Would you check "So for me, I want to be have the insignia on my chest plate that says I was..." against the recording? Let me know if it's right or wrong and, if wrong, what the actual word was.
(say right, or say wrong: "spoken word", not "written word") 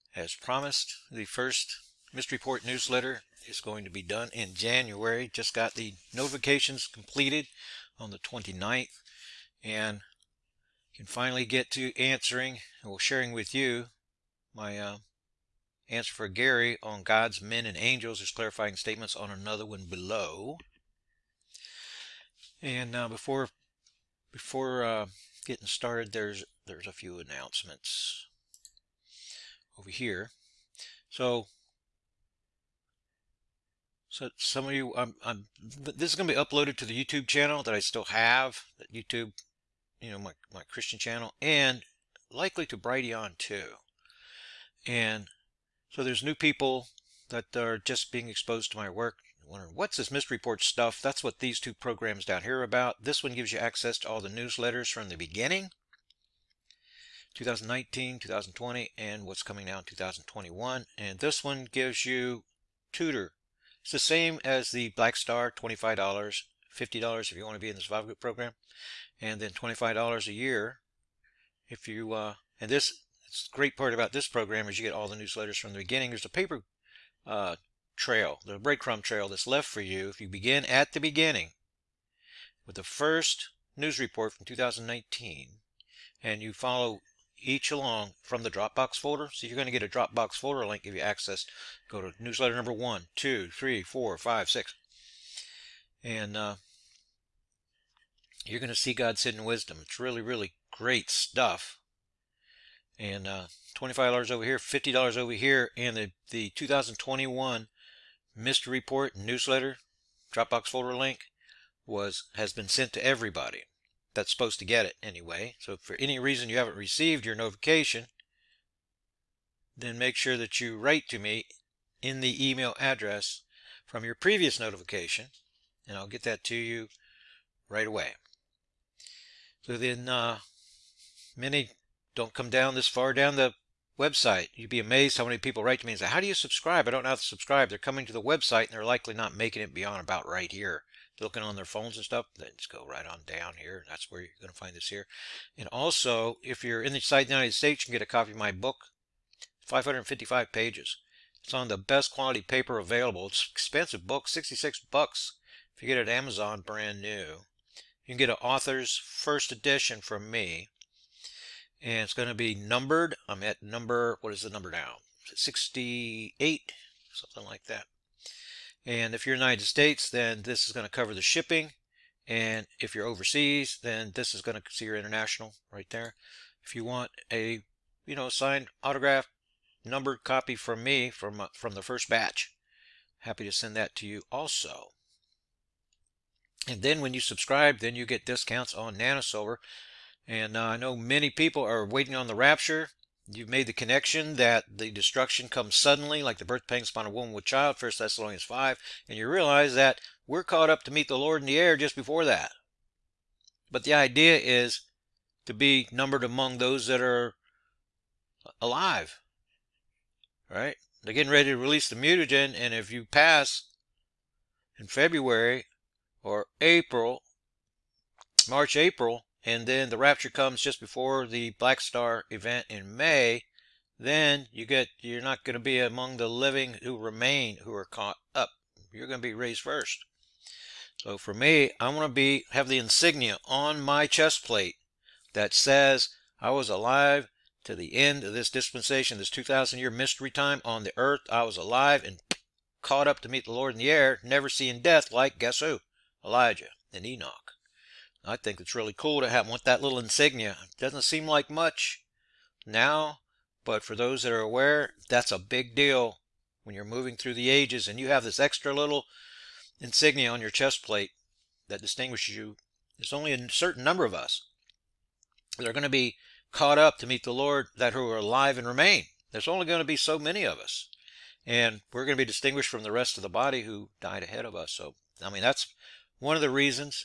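right.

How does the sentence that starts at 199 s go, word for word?
And you realize that we're caught up to meet the Lord in the air just before that.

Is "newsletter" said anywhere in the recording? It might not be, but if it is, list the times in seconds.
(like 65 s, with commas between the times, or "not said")
2 s, 54 s, 75 s, 92 s, 109 s.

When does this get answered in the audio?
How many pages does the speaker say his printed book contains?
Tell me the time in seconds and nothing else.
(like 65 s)
149 s.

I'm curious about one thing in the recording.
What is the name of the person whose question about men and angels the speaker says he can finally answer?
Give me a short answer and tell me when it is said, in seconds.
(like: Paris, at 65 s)
Gary, at 16 s.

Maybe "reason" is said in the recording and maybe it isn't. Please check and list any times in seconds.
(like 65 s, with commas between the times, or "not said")
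116 s, 276 s.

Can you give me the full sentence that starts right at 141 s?
They're looking on their phones and stuff, Then just go right on down here.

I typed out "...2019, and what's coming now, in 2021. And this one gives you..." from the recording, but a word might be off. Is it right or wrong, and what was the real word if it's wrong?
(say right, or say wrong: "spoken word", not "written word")
wrong: "2020", not "2019".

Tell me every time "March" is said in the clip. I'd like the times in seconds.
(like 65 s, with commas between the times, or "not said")
218 s.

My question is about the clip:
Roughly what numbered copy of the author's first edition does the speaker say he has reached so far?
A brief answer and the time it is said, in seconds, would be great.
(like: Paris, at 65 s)
68, at 165 s.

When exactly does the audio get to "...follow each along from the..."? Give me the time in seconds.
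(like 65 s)
86 s.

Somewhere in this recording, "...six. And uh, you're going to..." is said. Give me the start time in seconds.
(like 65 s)
94 s.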